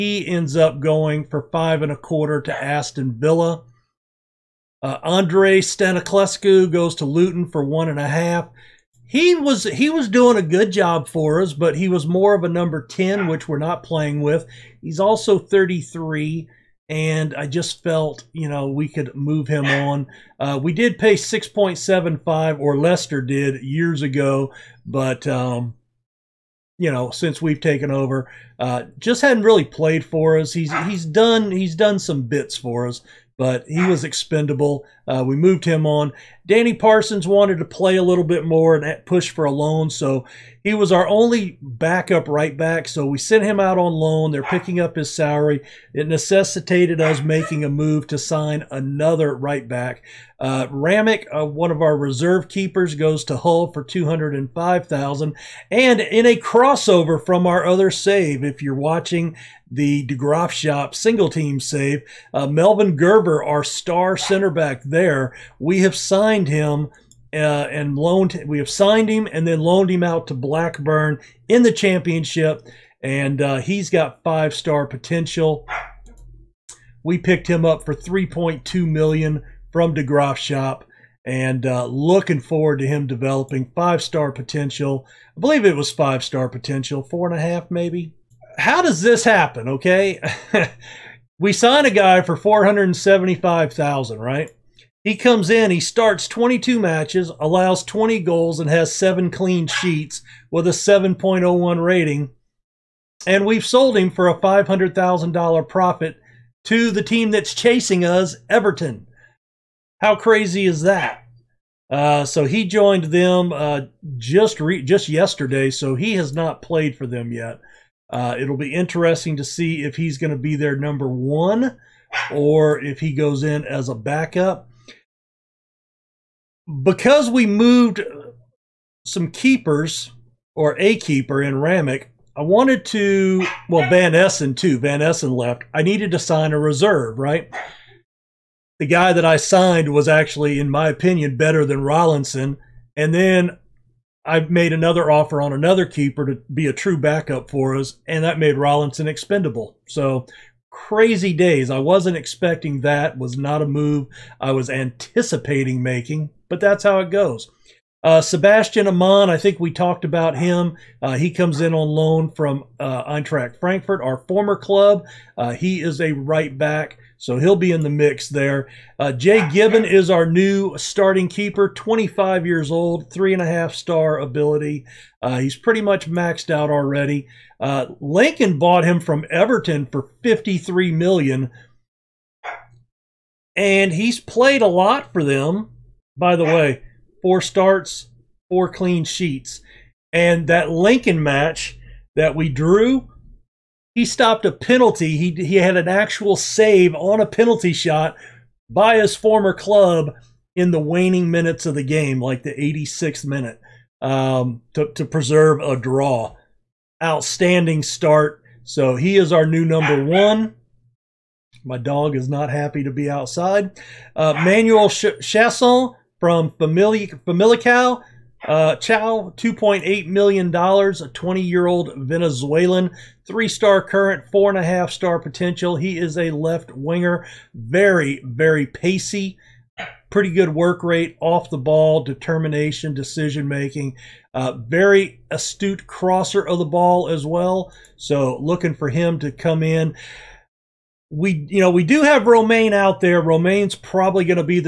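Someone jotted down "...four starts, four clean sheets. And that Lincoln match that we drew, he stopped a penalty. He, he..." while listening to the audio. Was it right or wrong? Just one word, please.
right.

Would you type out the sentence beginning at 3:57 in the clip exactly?
So, looking for him to come in we you know we do have Romaine out there.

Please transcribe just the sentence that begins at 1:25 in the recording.
I believe it was five star potential, four and a half maybe.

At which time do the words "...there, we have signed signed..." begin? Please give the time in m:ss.
1:04.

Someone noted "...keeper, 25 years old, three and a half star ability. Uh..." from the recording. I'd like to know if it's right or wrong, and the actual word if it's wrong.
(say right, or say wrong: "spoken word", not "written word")
right.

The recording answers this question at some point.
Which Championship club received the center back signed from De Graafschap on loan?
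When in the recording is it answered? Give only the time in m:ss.
1:10.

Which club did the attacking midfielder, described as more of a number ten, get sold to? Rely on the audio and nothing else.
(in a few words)
Luton.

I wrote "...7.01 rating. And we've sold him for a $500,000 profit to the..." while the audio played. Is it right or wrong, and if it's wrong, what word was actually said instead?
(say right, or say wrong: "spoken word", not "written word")
right.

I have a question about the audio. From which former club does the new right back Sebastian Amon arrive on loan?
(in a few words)
Eintracht Frankfurt.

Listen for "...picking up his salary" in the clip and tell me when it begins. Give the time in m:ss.
0:44.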